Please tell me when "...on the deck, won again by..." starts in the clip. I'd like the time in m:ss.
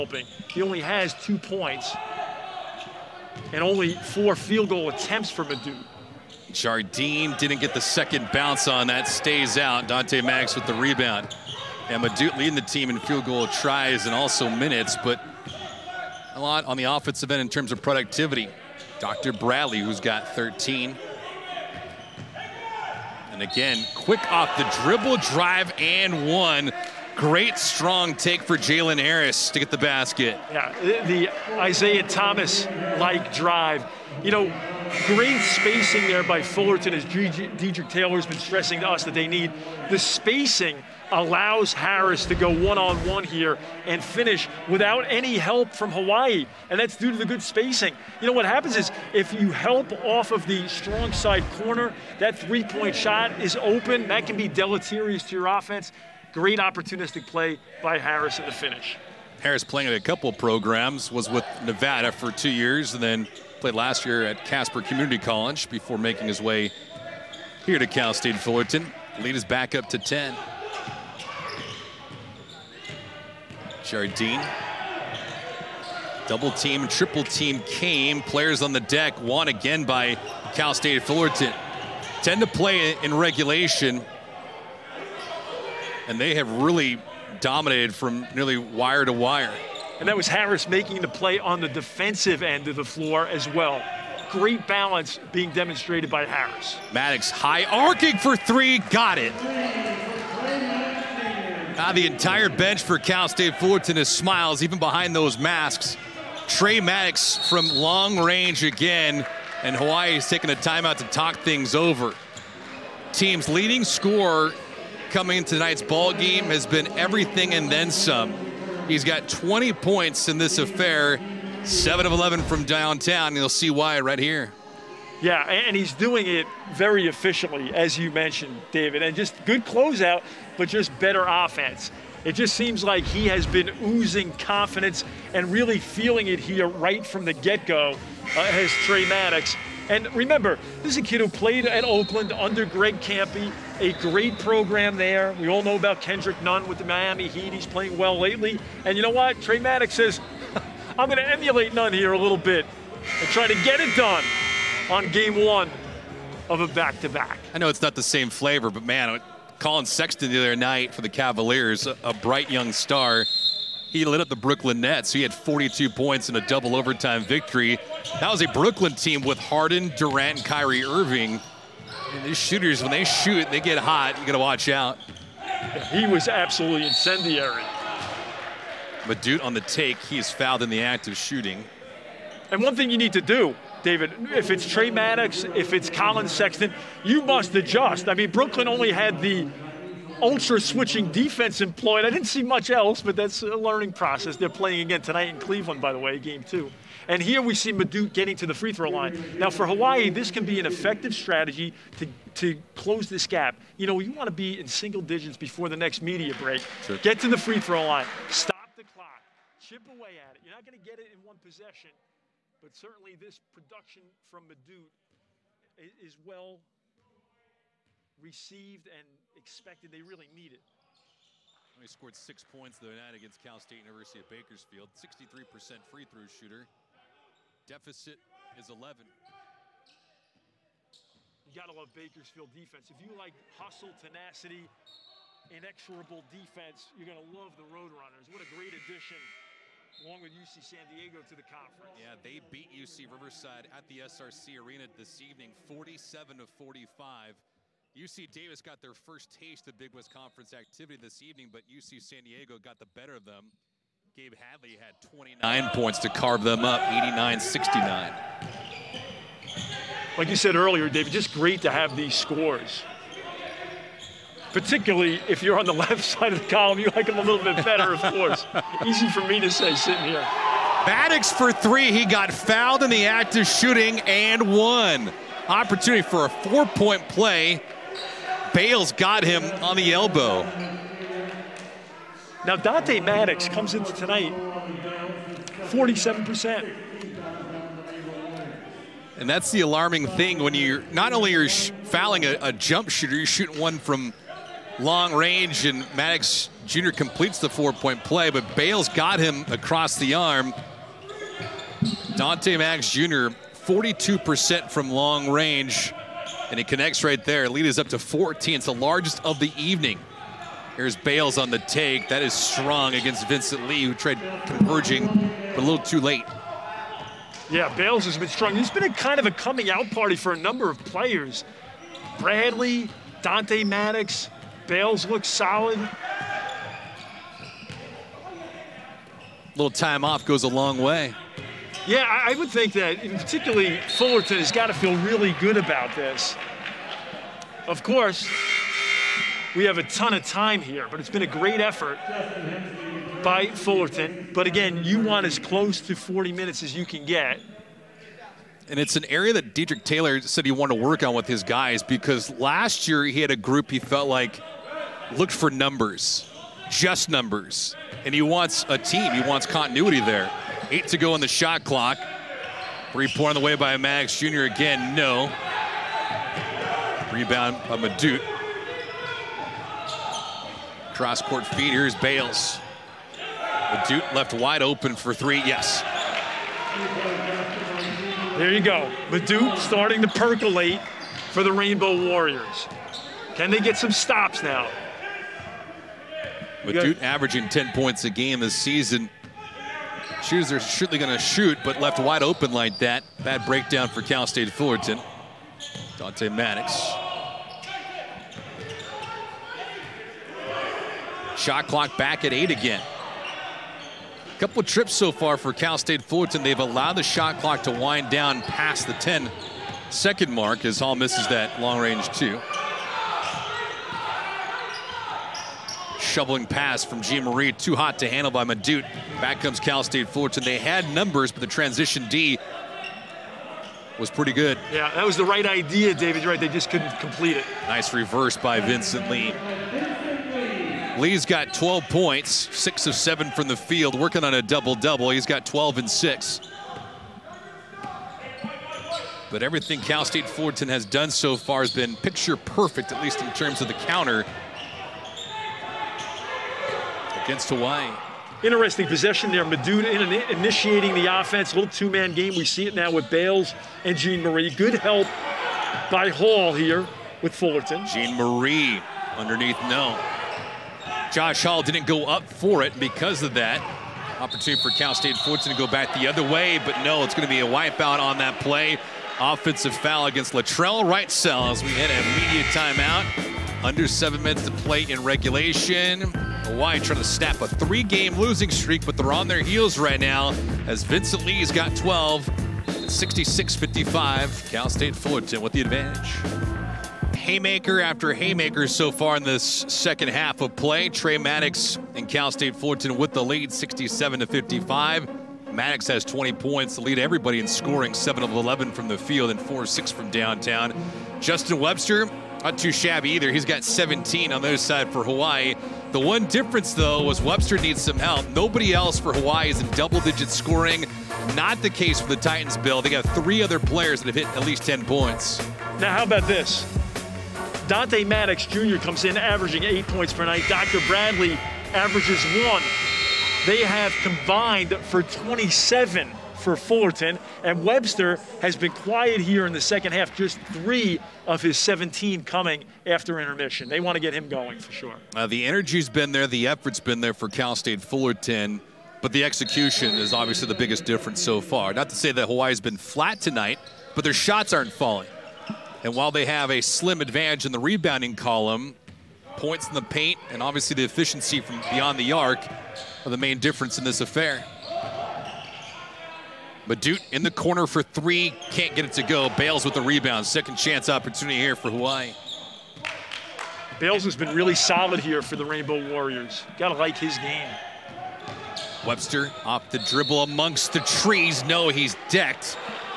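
1:18.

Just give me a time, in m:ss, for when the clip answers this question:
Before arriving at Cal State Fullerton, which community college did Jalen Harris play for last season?
1:04.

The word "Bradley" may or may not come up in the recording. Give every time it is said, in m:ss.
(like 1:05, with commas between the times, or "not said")
0:19, 5:22, 8:40.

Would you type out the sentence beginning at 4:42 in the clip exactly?
Now Dante Maddox comes into tonight 47%.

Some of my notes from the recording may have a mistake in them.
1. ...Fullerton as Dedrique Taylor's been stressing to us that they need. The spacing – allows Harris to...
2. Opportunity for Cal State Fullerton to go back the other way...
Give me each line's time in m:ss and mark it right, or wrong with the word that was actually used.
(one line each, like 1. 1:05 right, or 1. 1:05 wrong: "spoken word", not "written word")
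1. 0:36 right
2. 7:44 right.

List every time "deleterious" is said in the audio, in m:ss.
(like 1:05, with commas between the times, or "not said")
0:54.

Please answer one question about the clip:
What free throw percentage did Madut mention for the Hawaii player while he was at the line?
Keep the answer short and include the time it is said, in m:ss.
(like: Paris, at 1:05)
63%, at 3:44.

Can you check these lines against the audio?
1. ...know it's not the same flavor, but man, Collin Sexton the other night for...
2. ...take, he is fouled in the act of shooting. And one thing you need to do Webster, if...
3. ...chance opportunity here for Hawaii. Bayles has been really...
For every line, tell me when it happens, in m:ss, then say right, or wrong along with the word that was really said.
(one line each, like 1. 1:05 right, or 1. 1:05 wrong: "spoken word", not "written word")
1. 2:37 right
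2. 2:59 wrong: "David", not "Webster"
3. 9:20 right.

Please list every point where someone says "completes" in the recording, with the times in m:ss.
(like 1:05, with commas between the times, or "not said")
4:56, 7:06.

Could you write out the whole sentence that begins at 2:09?
And just good closeout, but just better offense.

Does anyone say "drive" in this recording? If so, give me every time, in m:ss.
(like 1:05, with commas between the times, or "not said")
0:25, 0:33.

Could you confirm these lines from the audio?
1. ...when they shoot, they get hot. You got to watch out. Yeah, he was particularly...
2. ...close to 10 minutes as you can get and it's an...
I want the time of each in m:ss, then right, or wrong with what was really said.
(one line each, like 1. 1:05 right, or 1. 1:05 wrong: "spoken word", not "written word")
1. 2:52 wrong: "absolutely", not "particularly"
2. 5:45 wrong: "40", not "10".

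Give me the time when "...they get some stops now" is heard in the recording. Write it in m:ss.
6:23.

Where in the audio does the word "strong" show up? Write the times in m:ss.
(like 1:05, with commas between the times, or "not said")
0:27, 0:50, 5:12, 5:18.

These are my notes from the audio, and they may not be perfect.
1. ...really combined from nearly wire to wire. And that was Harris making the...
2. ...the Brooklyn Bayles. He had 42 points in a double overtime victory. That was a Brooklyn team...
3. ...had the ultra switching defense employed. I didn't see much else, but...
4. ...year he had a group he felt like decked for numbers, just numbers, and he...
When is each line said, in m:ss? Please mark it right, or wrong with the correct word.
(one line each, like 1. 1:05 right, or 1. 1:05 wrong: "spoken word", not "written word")
1. 1:26 wrong: "dominated", not "combined"
2. 2:44 wrong: "Nets", not "Bayles"
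3. 3:08 right
4. 5:52 wrong: "looked", not "decked".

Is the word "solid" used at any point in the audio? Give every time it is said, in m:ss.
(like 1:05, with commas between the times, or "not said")
5:25, 9:24.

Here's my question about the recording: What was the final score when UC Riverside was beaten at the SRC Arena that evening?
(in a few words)
47 to 45.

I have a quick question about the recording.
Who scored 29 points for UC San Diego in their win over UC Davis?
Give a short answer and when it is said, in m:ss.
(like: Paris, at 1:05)
Gabe Hadley, at 4:14.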